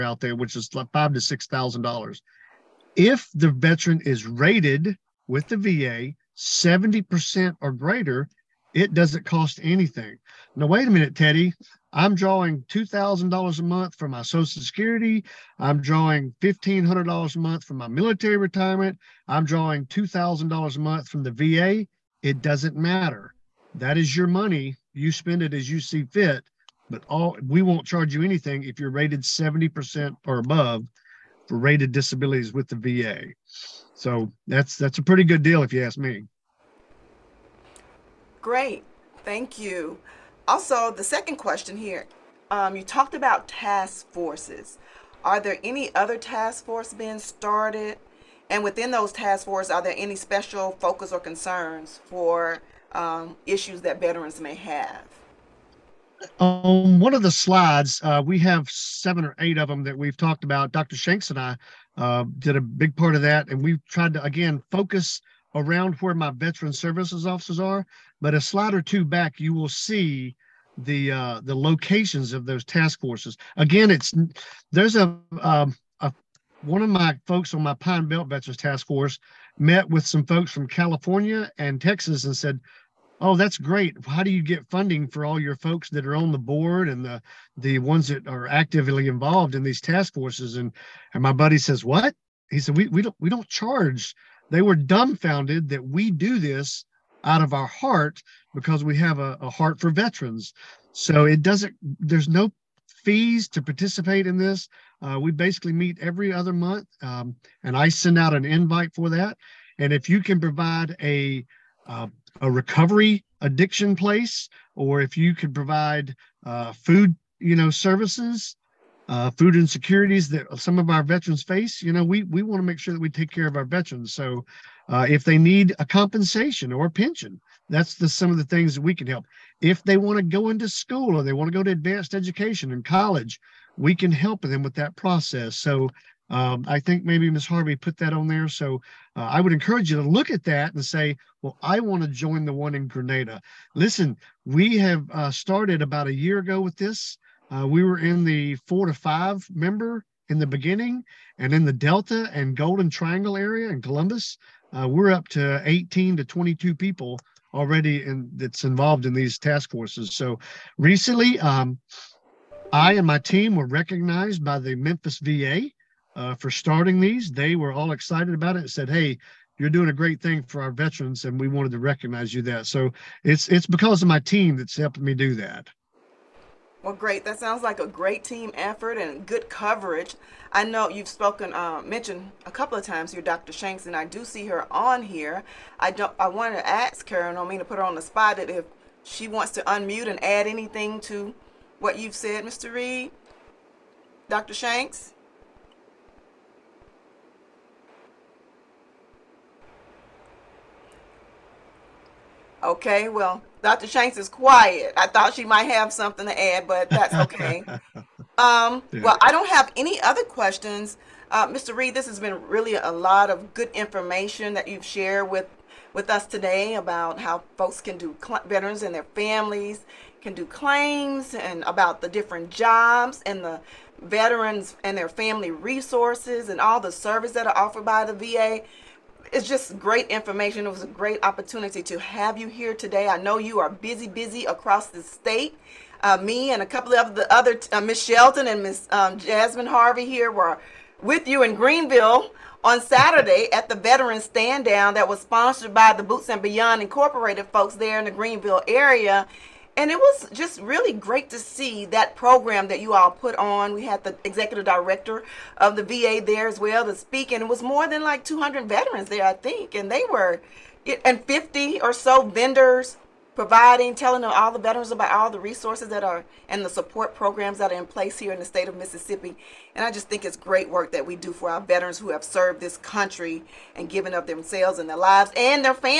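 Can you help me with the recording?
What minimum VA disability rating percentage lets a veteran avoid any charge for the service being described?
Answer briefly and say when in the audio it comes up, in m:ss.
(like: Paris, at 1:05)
70%, at 0:06.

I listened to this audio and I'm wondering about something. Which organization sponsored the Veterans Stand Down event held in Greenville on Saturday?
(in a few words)
Boots and Beyond Incorporated.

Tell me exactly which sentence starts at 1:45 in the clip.
Uh, we basically meet every other month, um, and I send out an invite for that.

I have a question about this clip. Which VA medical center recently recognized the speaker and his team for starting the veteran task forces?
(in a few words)
Memphis VA.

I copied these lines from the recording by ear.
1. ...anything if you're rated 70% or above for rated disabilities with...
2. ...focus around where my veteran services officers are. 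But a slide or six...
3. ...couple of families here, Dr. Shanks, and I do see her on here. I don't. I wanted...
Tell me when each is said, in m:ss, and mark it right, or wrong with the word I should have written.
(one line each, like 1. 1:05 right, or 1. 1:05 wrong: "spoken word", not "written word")
1. 0:28 right
2. 1:04 wrong: "two", not "six"
3. 3:02 wrong: "times", not "families".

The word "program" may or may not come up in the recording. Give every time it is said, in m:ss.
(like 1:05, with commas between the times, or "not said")
4:12, 4:27.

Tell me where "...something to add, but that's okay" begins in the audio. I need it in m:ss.
3:25.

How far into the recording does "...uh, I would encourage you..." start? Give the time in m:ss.
2:19.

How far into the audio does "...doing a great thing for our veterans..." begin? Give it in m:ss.
2:49.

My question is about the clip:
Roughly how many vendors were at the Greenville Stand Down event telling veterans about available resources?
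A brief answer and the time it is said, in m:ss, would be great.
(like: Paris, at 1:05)
50, at 4:21.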